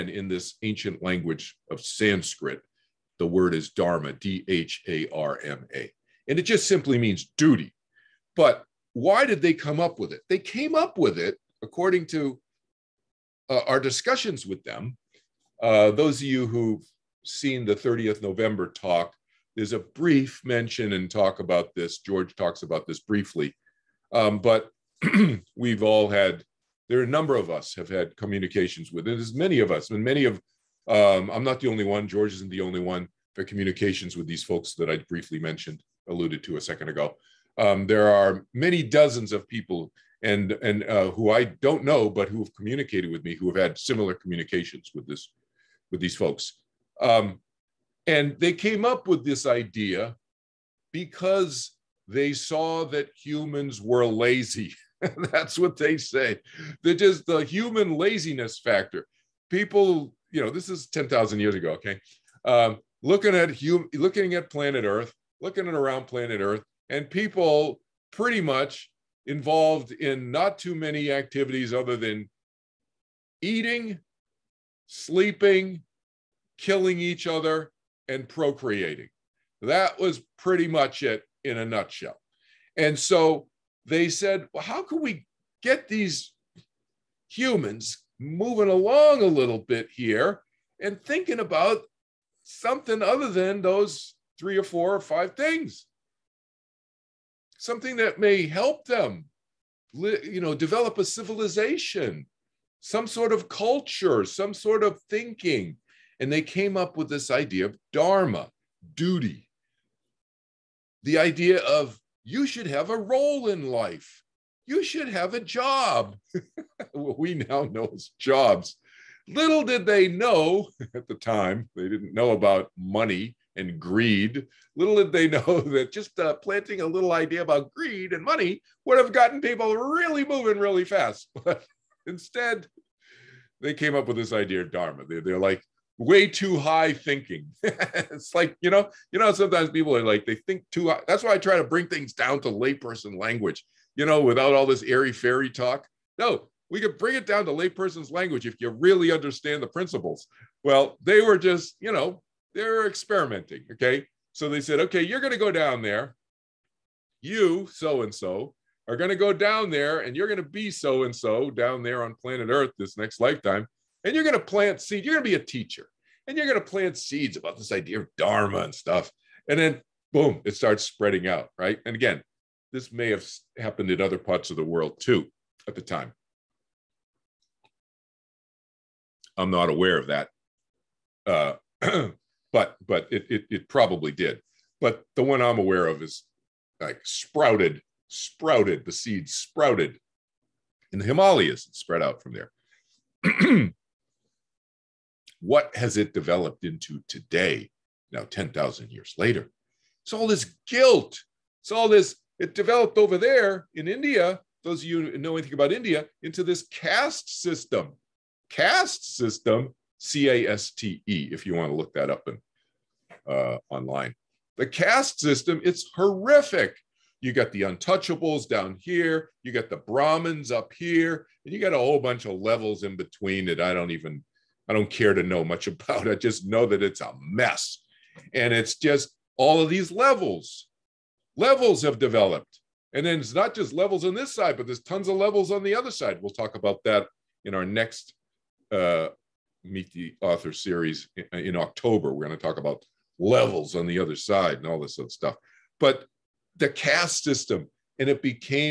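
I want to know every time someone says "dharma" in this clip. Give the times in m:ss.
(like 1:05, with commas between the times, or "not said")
0:03, 1:47, 2:14, 2:48.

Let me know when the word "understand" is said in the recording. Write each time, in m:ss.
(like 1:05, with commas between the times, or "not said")
2:29.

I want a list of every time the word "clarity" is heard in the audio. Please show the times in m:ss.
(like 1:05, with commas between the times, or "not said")
not said.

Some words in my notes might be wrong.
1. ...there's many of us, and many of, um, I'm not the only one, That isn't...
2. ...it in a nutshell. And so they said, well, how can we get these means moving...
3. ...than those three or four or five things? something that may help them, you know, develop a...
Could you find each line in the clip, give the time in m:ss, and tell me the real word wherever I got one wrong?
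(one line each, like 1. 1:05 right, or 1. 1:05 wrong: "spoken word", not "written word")
1. 0:29 wrong: "George", not "That"
2. 1:21 wrong: "humans", not "means"
3. 1:33 right.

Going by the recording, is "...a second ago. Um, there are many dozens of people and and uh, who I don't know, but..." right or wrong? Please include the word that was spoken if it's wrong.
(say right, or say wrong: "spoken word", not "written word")
right.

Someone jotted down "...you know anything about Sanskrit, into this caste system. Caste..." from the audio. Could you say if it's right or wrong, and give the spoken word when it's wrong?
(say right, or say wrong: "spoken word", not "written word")
wrong: "India", not "Sanskrit".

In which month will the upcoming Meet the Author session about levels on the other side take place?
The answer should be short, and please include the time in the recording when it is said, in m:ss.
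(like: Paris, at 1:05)
October, at 4:01.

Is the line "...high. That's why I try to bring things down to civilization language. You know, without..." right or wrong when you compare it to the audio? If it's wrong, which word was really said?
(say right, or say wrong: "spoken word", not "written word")
wrong: "layperson", not "civilization".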